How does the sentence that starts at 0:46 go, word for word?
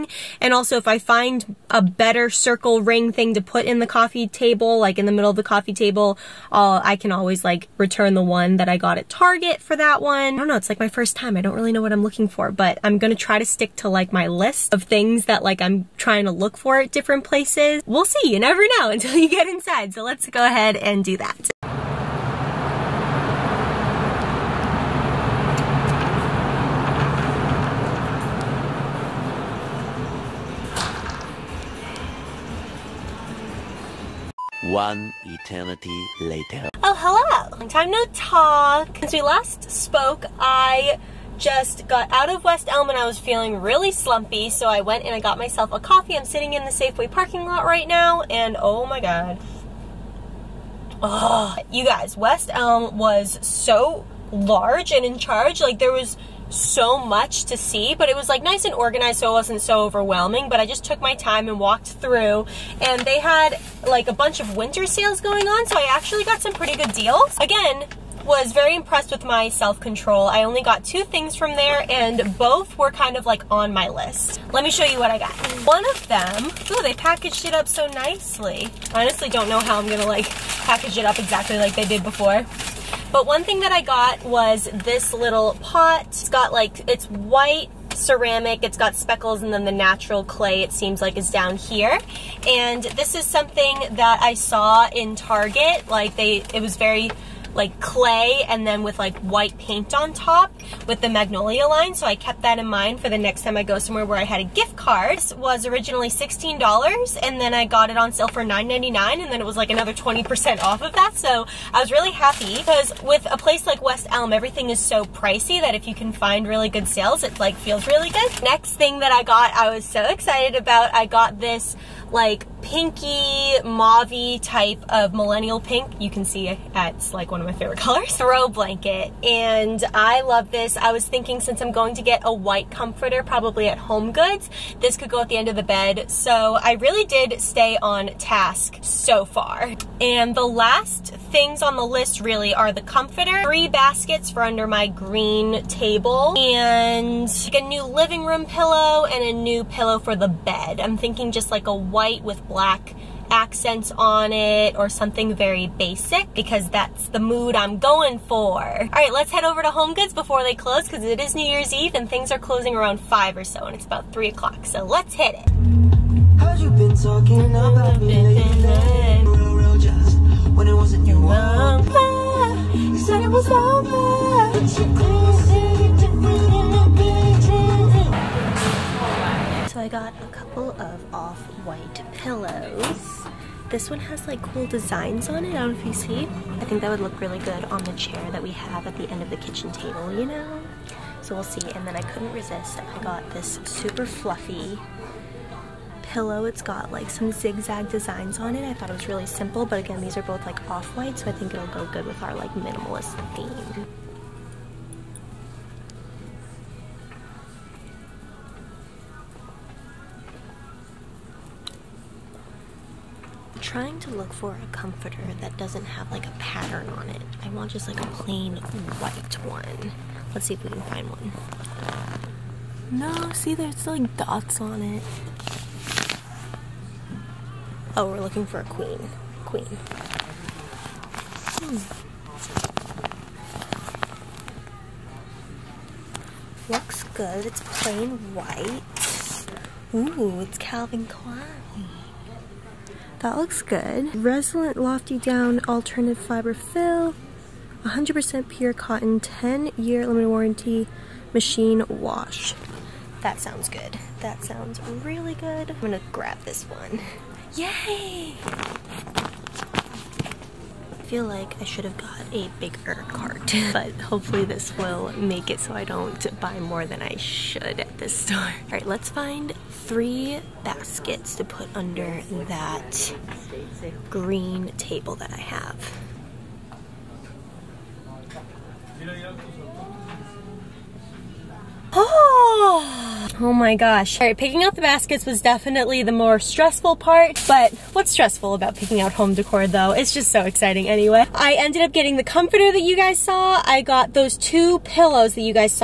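I'm sitting in the Safeway parking lot right now, and oh my god.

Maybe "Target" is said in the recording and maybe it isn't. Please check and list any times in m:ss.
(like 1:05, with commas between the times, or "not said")
0:09, 1:35.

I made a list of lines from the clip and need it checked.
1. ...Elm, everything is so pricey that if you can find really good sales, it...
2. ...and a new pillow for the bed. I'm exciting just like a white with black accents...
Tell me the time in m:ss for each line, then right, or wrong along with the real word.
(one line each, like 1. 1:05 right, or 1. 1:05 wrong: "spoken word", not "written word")
1. 1:54 right
2. 2:29 wrong: "thinking", not "exciting".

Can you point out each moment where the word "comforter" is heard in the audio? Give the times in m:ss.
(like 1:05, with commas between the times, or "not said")
2:12, 2:22, 3:34, 4:52.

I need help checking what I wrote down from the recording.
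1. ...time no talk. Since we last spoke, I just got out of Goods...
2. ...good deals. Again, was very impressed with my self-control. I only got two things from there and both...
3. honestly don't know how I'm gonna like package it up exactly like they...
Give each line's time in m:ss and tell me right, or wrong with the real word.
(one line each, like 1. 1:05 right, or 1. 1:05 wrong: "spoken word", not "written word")
1. 0:37 wrong: "West", not "Goods"
2. 1:06 right
3. 1:18 right.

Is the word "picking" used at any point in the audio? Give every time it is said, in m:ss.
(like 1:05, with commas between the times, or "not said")
4:44, 4:48.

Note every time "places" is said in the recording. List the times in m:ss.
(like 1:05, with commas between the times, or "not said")
0:17, 1:53.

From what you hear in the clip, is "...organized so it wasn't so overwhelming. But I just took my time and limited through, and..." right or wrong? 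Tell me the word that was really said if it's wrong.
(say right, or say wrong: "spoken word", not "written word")
wrong: "walked", not "limited".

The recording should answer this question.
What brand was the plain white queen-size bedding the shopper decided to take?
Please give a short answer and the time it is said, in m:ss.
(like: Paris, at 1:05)
Calvin Klein, at 4:00.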